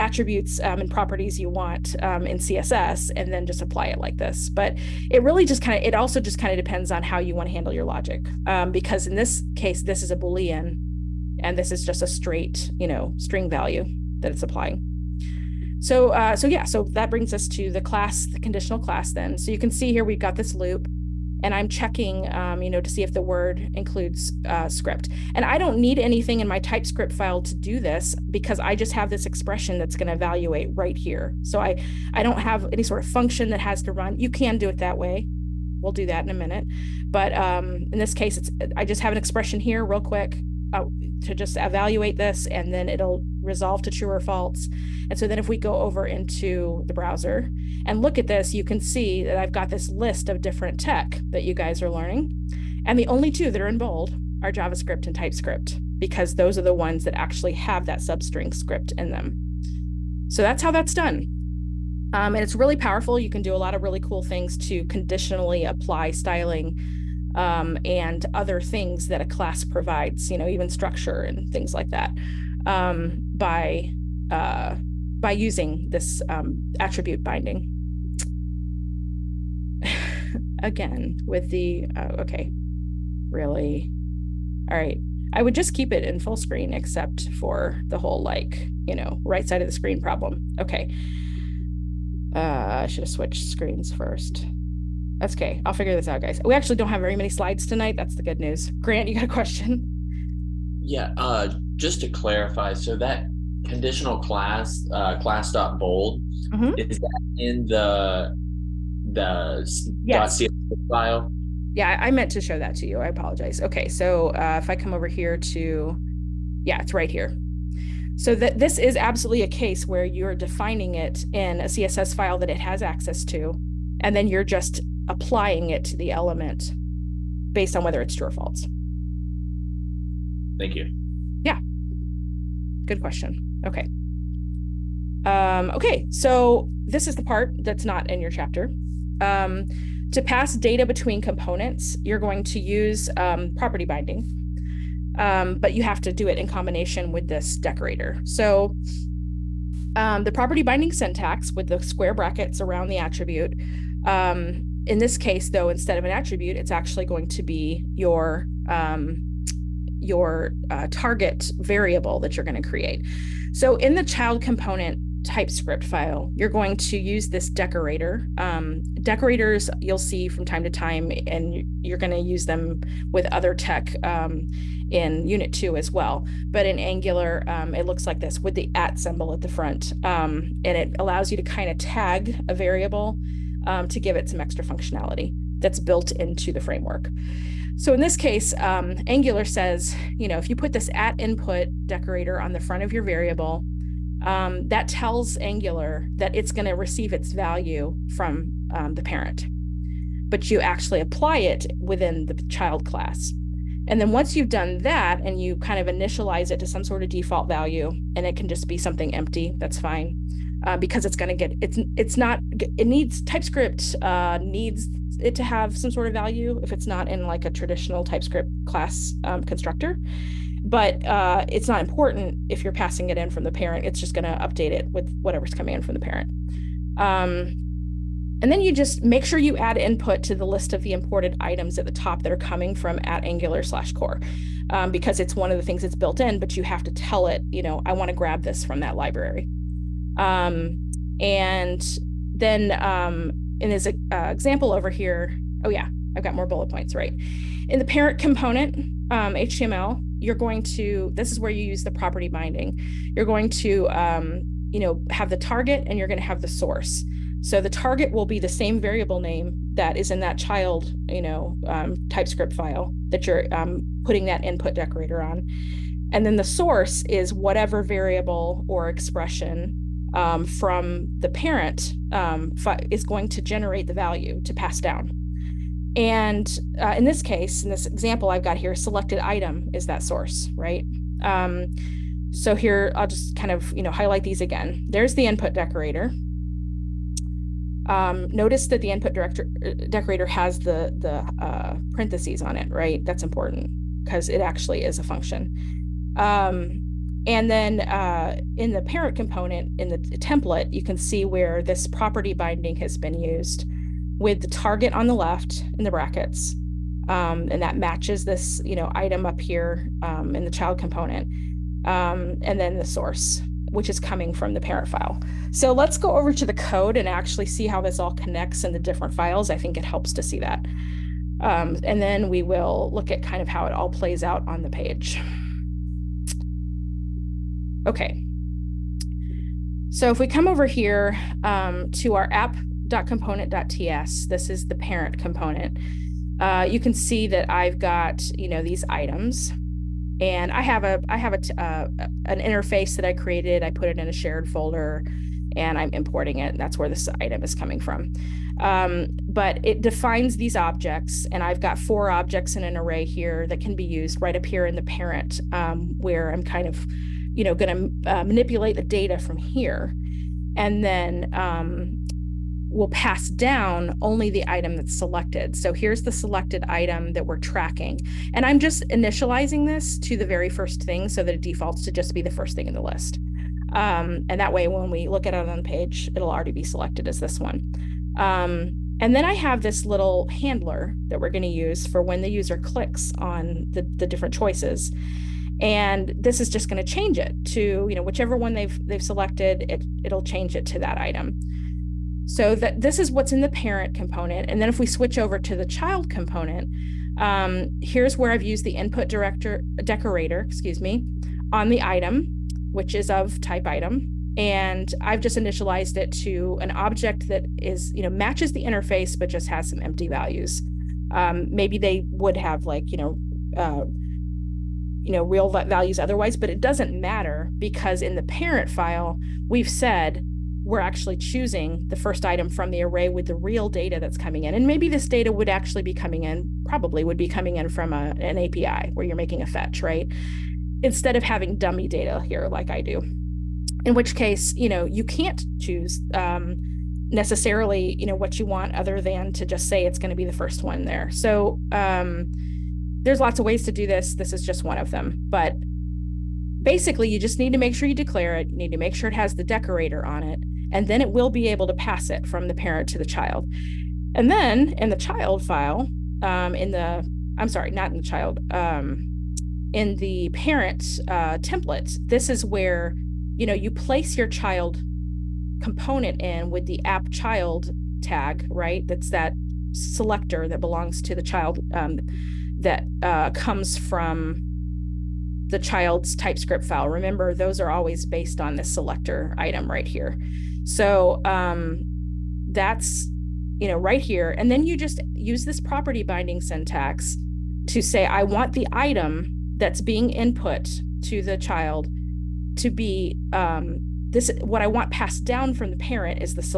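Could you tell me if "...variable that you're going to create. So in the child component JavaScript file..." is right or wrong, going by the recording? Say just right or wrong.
wrong.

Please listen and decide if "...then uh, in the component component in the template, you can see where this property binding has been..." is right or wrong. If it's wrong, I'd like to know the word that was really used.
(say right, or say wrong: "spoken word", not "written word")
wrong: "parent", not "component".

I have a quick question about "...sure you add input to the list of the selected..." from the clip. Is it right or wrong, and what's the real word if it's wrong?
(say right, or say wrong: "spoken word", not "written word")
wrong: "imported", not "selected".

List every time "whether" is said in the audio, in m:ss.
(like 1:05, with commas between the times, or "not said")
2:07.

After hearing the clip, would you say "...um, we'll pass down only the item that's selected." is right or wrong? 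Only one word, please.
right.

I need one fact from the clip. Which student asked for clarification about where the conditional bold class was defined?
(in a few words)
Grant.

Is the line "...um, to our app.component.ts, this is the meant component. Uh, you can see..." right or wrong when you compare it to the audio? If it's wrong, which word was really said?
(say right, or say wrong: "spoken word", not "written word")
wrong: "parent", not "meant".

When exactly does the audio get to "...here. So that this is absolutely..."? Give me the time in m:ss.
1:57.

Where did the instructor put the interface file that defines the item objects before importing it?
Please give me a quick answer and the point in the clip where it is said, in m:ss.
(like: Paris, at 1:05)
a shared folder, at 5:44.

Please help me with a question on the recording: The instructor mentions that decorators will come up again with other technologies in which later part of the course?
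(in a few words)
Unit 2.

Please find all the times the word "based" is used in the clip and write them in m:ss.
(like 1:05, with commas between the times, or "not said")
2:07, 7:58.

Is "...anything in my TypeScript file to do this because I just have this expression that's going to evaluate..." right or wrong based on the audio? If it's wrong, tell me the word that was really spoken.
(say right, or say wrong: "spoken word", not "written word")
right.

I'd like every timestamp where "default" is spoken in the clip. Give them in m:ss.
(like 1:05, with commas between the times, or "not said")
3:27, 6:11.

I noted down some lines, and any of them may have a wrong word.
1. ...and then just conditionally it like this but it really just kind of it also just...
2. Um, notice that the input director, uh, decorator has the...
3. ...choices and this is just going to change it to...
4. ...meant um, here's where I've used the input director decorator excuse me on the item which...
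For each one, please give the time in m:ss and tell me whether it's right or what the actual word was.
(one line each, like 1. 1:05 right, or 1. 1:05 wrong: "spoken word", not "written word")
1. 0:03 wrong: "apply", not "conditionally"
2. 4:47 right
3. 6:24 right
4. 6:36 wrong: "component", not "meant".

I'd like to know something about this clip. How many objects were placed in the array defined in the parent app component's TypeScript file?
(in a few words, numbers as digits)
4.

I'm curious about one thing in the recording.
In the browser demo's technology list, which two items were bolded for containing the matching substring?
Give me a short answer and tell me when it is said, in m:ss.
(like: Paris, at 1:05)
JavaScript and TypeScript, at 0:54.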